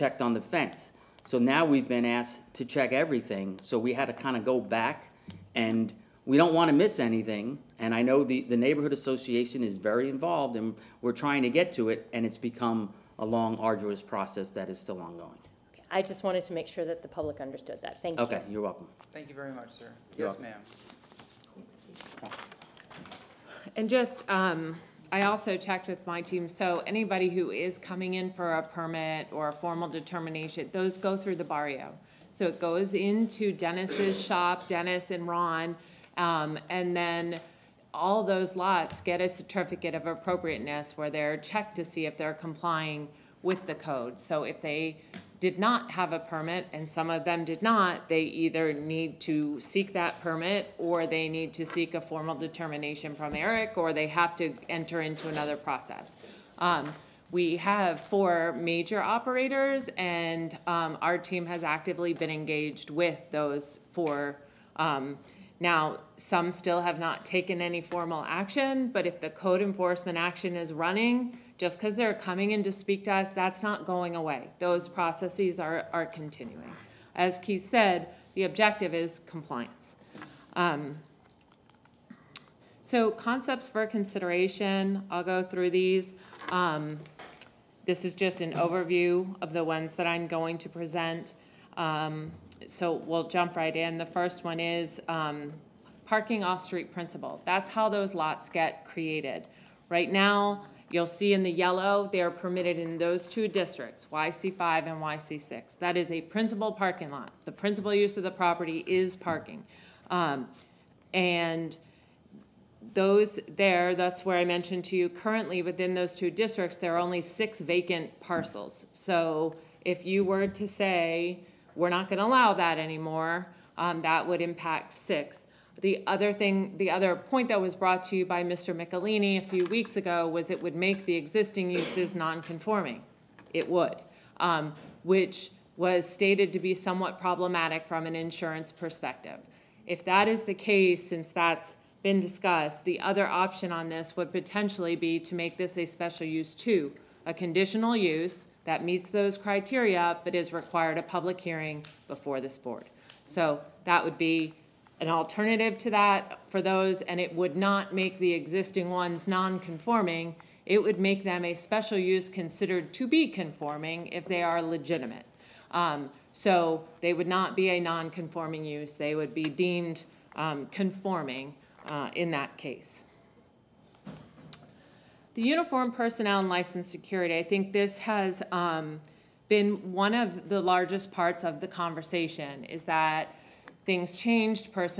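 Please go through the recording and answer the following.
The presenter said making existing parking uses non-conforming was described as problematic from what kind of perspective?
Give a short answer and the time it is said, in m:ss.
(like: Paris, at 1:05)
Insurance, at 2:18.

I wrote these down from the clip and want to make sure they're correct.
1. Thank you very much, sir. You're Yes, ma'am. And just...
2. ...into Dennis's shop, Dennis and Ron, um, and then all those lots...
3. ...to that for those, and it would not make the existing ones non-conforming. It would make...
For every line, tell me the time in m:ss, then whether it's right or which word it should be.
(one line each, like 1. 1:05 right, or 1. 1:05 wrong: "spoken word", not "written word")
1. 0:19 right
2. 0:32 right
3. 2:35 right.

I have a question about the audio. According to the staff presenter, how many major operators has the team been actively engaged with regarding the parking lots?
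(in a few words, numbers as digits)
4.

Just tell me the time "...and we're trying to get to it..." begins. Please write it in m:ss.
0:10.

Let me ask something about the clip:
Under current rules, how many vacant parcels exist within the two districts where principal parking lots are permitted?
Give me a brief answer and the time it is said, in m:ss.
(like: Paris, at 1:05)
6, at 1:56.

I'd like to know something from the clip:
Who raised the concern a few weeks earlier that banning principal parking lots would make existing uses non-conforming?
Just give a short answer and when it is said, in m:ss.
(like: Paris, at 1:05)
Mr. Michelini, at 2:08.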